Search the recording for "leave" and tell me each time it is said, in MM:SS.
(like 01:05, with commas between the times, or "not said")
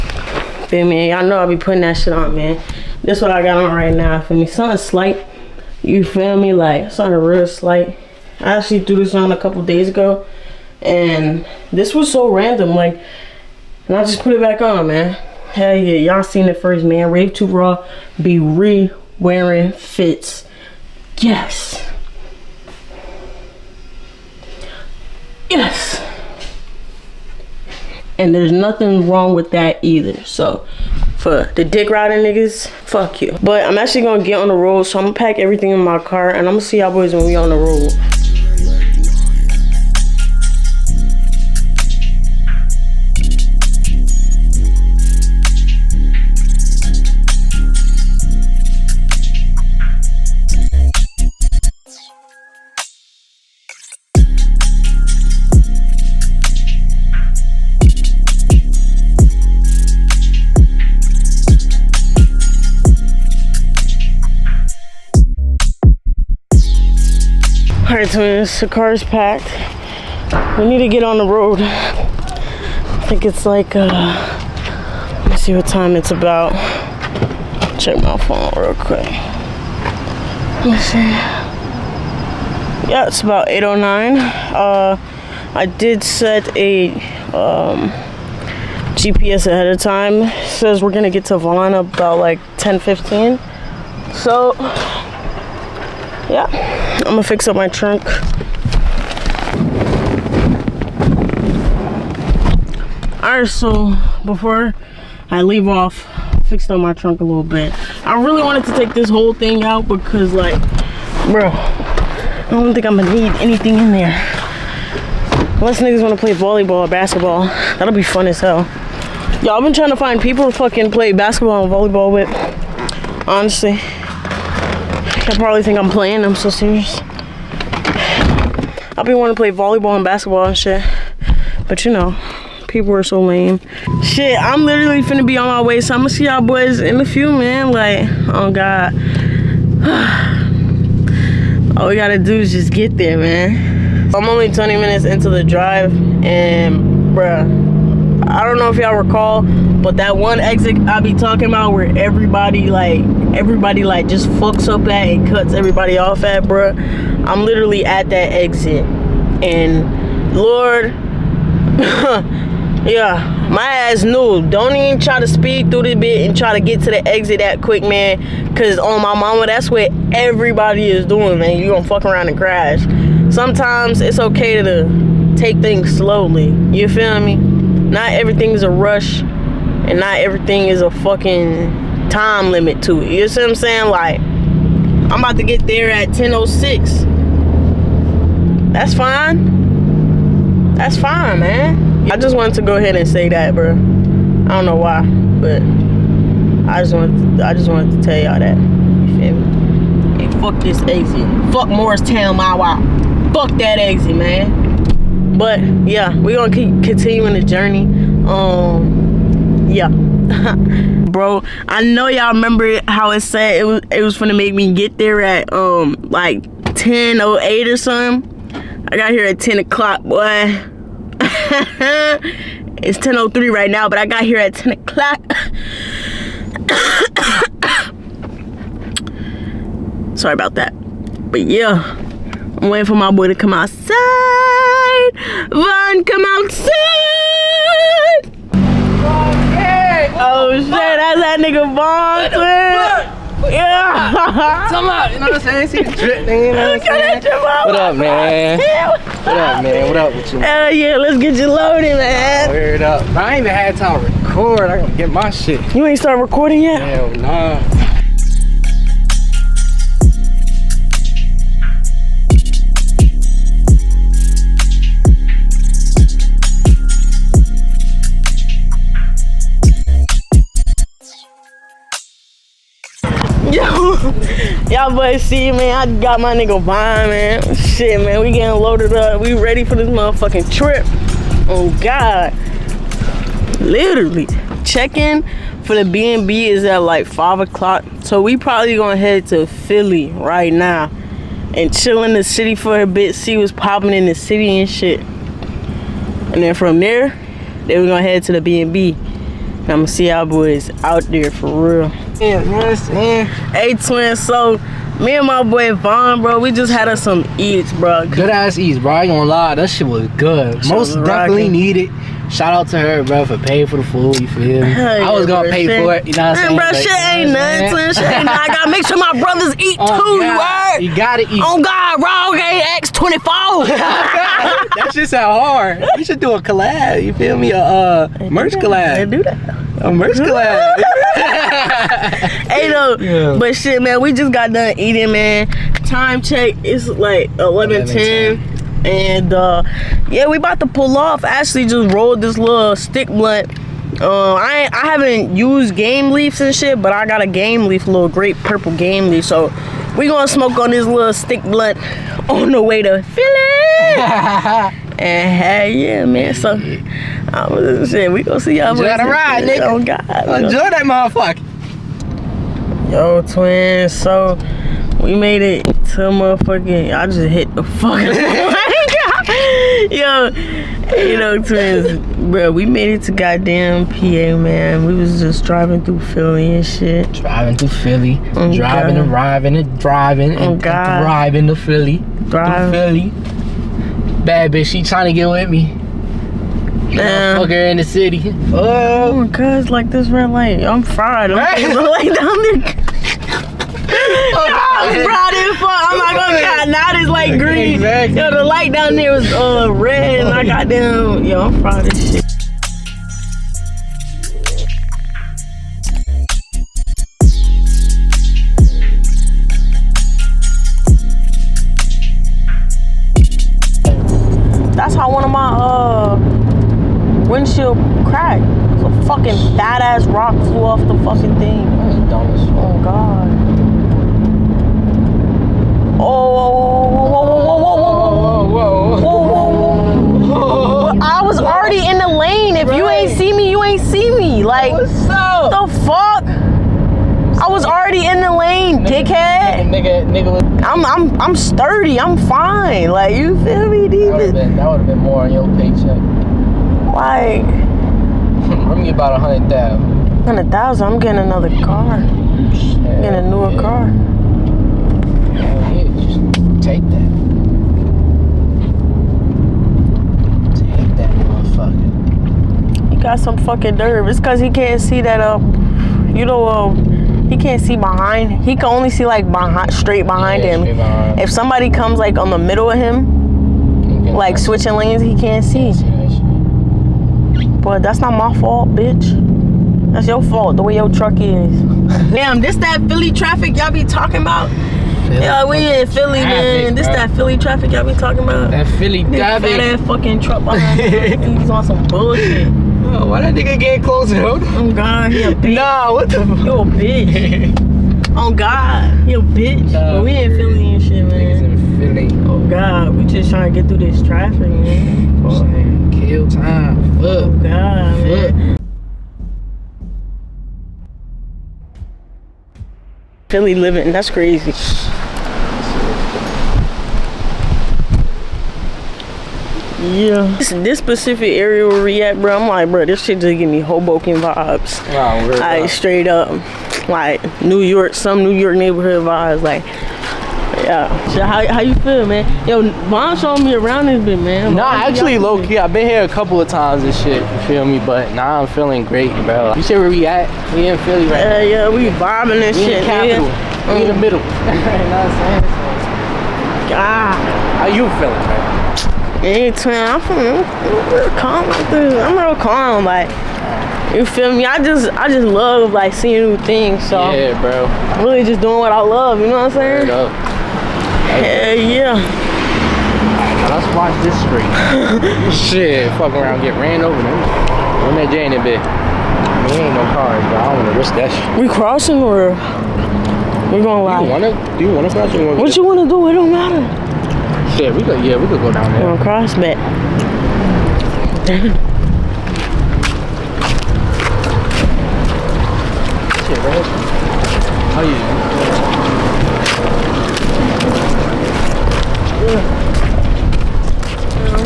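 01:45, 05:46.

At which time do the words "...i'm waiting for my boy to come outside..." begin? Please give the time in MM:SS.
03:52.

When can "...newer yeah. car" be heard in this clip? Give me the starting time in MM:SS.
07:33.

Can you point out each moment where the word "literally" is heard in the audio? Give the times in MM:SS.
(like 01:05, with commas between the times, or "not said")
02:14, 02:37, 04:43.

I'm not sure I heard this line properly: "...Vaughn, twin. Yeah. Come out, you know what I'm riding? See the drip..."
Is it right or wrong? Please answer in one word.
wrong.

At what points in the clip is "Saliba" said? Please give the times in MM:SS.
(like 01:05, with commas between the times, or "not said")
not said.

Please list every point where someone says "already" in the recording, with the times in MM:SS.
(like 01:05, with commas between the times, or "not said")
07:11, 07:17.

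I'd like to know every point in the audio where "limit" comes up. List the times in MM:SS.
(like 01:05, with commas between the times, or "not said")
03:02.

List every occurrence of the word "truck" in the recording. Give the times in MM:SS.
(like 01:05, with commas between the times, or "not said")
08:00, 08:10.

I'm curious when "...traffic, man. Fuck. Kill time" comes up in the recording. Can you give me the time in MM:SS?
08:24.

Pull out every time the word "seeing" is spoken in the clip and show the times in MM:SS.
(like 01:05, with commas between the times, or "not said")
09:15.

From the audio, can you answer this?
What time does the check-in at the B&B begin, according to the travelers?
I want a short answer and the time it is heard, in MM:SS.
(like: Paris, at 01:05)
5 o'clock, at 04:47.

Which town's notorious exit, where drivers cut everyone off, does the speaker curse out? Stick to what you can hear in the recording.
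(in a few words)
Morristown.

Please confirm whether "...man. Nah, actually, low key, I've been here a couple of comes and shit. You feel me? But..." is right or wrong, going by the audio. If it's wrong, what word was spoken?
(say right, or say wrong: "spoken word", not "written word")
wrong: "times", not "comes".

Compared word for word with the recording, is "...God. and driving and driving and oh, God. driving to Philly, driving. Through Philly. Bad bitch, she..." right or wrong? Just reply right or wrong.
right.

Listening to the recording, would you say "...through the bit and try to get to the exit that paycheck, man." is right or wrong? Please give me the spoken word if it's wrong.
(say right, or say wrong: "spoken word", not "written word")
wrong: "quick", not "paycheck".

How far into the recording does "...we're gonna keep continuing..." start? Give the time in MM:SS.
03:26.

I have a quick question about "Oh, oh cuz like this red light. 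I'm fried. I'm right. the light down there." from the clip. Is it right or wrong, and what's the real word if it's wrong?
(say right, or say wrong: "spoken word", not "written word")
right.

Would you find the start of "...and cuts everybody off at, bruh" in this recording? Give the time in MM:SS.
02:35.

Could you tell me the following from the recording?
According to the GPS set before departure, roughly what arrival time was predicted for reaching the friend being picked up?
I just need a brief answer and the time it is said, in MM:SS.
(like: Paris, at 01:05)
10:15, at 01:32.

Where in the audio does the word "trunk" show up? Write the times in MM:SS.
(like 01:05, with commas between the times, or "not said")
01:37, 01:46.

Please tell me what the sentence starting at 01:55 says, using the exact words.
Unless niggas wanna play volleyball or basketball.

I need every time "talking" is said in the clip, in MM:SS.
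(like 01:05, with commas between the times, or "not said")
02:31, 08:03, 08:07.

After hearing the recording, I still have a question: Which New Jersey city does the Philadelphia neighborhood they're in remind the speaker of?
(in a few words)
Hoboken.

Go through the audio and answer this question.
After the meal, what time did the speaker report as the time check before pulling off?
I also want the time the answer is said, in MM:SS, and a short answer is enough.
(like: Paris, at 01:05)
11:10, at 05:37.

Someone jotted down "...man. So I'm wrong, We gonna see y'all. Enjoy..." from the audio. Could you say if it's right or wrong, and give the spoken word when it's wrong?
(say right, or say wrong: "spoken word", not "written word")
wrong: "saying", not "wrong".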